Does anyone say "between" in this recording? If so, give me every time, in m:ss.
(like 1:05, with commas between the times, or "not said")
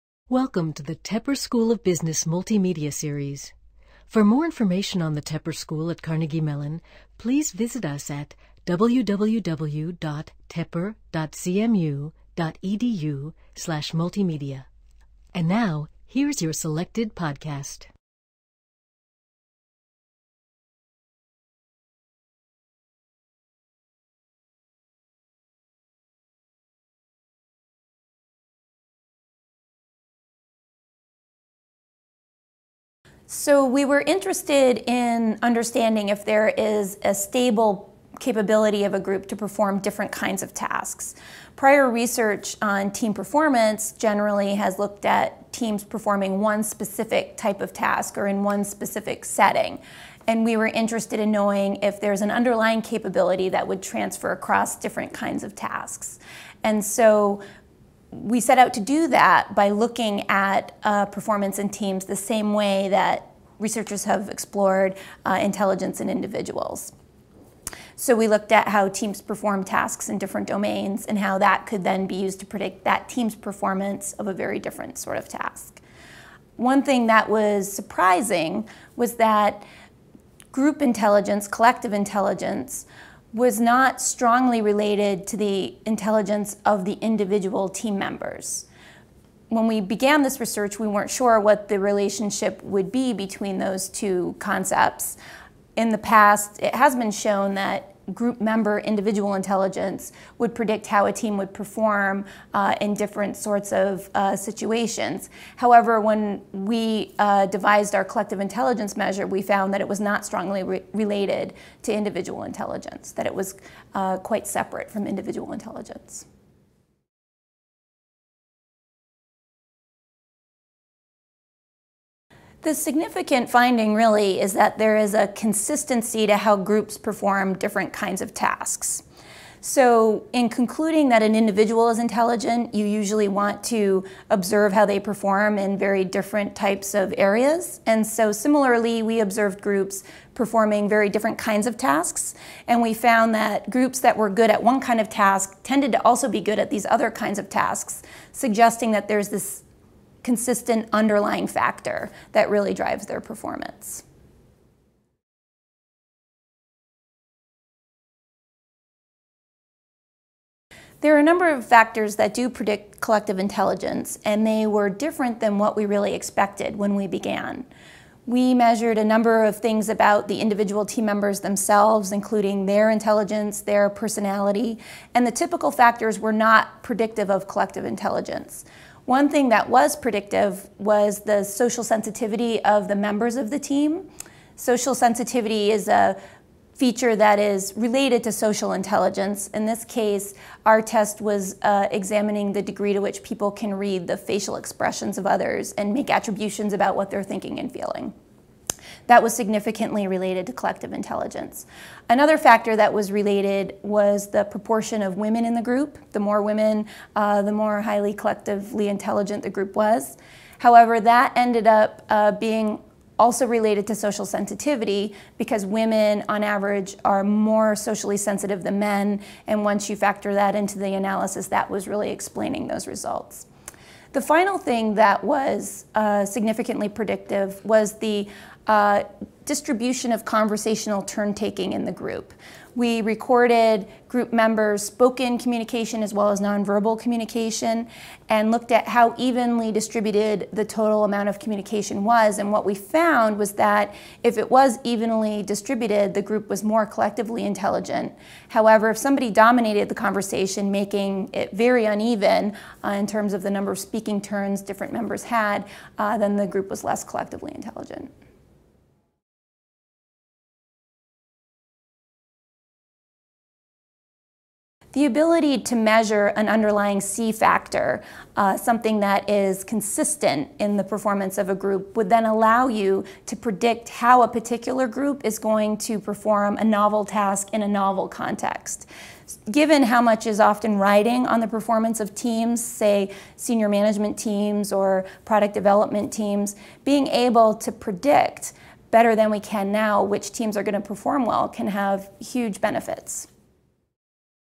1:33.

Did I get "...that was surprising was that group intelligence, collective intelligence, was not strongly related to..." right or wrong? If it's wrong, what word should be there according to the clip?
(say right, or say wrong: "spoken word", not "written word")
right.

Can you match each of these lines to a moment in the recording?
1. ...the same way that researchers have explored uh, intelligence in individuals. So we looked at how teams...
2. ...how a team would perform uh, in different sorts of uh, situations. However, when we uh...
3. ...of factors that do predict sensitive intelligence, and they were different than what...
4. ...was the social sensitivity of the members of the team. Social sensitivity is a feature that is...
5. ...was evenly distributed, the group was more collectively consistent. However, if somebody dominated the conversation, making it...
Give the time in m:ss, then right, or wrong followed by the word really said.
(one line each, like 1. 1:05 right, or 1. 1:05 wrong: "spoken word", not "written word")
1. 1:02 right
2. 1:40 right
3. 2:41 wrong: "collective", not "sensitive"
4. 3:00 right
5. 4:04 wrong: "intelligent", not "consistent".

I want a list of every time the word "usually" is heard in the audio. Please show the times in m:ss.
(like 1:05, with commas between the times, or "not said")
2:12.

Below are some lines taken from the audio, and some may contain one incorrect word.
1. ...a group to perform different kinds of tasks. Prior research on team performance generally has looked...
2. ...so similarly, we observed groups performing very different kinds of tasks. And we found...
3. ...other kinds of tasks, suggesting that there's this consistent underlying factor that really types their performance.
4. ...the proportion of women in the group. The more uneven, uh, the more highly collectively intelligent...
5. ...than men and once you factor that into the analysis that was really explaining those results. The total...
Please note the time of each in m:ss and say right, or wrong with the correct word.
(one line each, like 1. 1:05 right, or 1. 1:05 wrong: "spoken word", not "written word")
1. 0:38 right
2. 2:18 right
3. 2:26 wrong: "drives", not "types"
4. 3:24 wrong: "women", not "uneven"
5. 3:38 wrong: "final", not "total".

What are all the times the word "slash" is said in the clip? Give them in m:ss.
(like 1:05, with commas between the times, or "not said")
0:13.